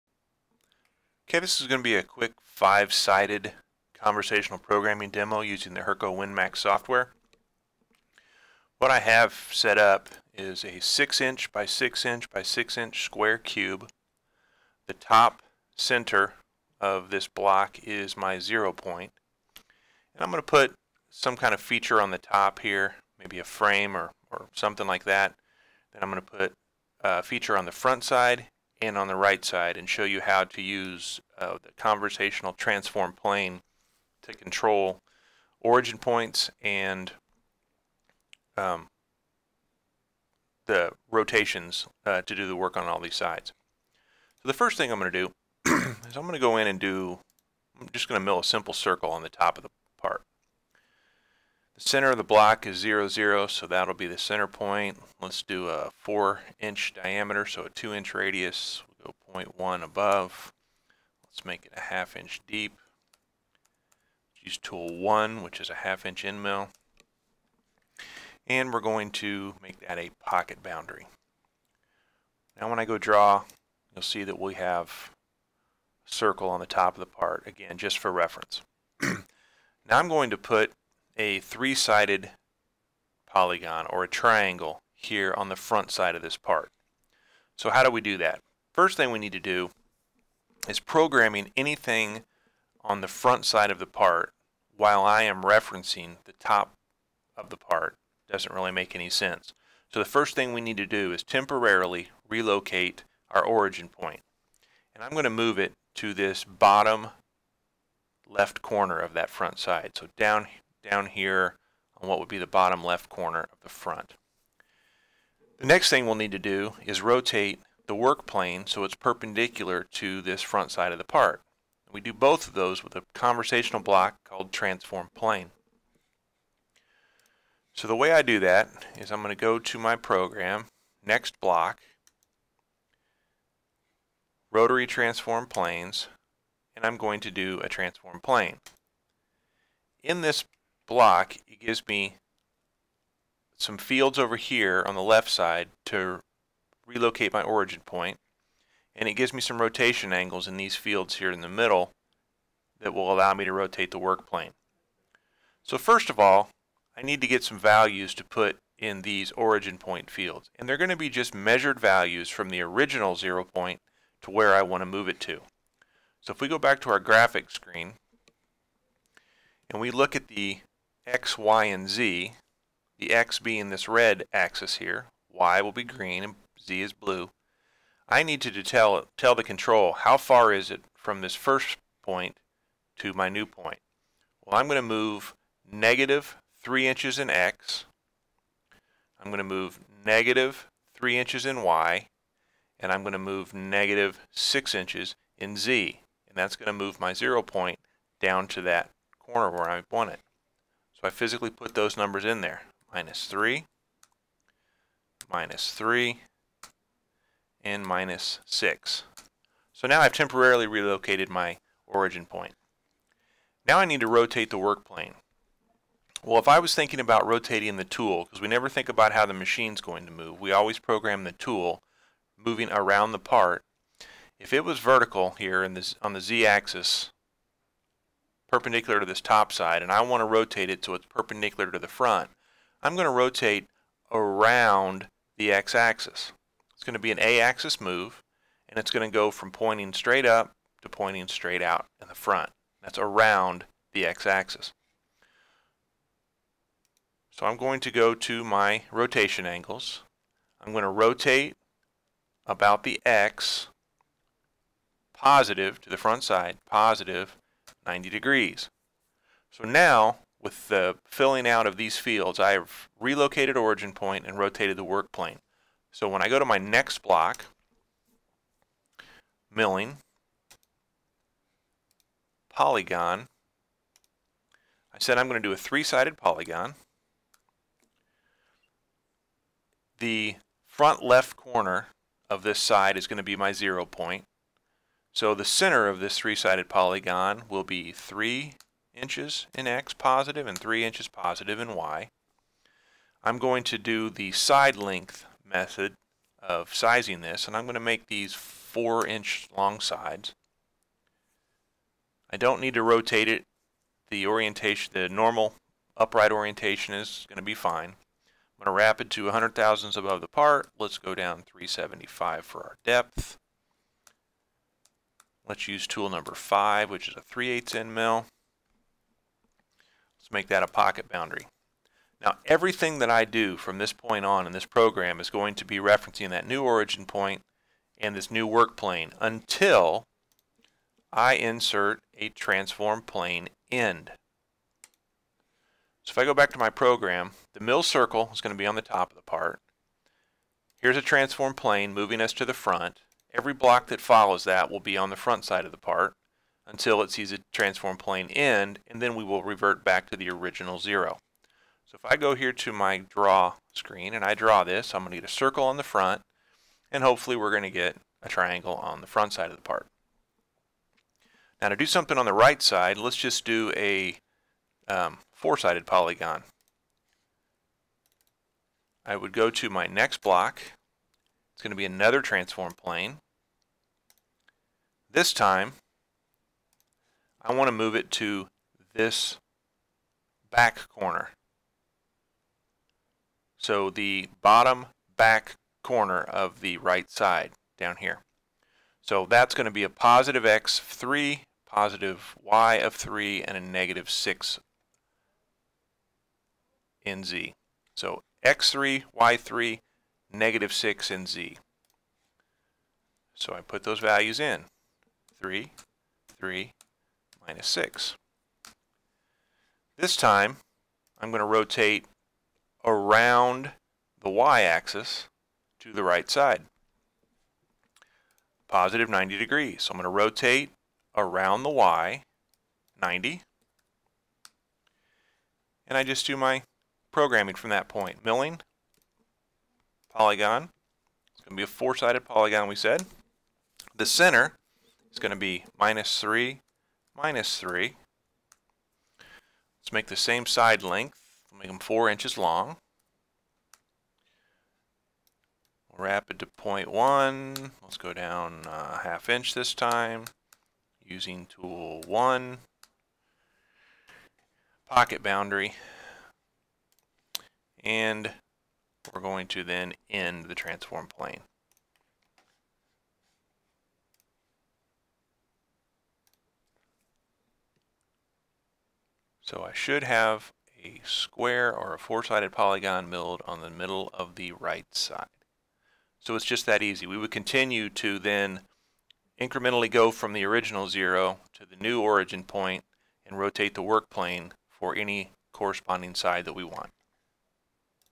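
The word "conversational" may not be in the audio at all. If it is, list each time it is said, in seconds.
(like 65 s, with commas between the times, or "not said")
3 s, 31 s, 123 s.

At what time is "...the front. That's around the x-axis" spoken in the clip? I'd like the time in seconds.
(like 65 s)
242 s.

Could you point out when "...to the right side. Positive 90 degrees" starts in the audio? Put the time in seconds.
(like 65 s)
415 s.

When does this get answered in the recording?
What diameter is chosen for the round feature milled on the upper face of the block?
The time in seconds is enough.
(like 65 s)
56 s.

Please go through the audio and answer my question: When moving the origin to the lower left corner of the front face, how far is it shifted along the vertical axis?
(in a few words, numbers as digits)
-6 inches.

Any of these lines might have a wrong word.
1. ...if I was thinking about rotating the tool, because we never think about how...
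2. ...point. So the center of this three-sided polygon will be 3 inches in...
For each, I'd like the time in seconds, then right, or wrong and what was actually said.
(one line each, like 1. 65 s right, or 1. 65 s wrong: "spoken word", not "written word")
1. 216 s right
2. 283 s right.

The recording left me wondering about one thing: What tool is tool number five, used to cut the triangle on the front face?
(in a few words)
3/8 end mill.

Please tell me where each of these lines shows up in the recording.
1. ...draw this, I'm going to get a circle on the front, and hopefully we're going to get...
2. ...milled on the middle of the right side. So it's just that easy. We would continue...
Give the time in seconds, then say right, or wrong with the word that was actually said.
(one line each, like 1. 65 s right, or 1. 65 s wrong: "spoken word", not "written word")
1. 354 s right
2. 473 s right.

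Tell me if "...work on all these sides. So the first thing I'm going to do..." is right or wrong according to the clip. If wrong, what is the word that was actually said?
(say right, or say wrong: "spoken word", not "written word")
right.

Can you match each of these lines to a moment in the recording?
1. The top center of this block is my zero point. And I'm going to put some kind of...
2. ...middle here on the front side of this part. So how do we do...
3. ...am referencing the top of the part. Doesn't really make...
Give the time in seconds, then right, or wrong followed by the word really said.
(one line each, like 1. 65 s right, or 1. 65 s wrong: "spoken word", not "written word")
1. 14 s right
2. 84 s wrong: "triangle", not "middle"
3. 95 s right.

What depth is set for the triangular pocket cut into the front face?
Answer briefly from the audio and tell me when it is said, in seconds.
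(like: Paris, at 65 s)
0.375, at 311 s.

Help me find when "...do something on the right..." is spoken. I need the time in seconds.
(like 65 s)
361 s.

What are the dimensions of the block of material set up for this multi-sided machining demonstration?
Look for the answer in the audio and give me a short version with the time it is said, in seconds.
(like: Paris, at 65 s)
6 x 6 x 6 inches, at 10 s.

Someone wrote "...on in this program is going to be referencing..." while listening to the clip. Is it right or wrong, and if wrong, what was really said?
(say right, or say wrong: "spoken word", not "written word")
right.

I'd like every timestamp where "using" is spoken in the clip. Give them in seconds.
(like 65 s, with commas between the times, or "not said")
5 s, 451 s.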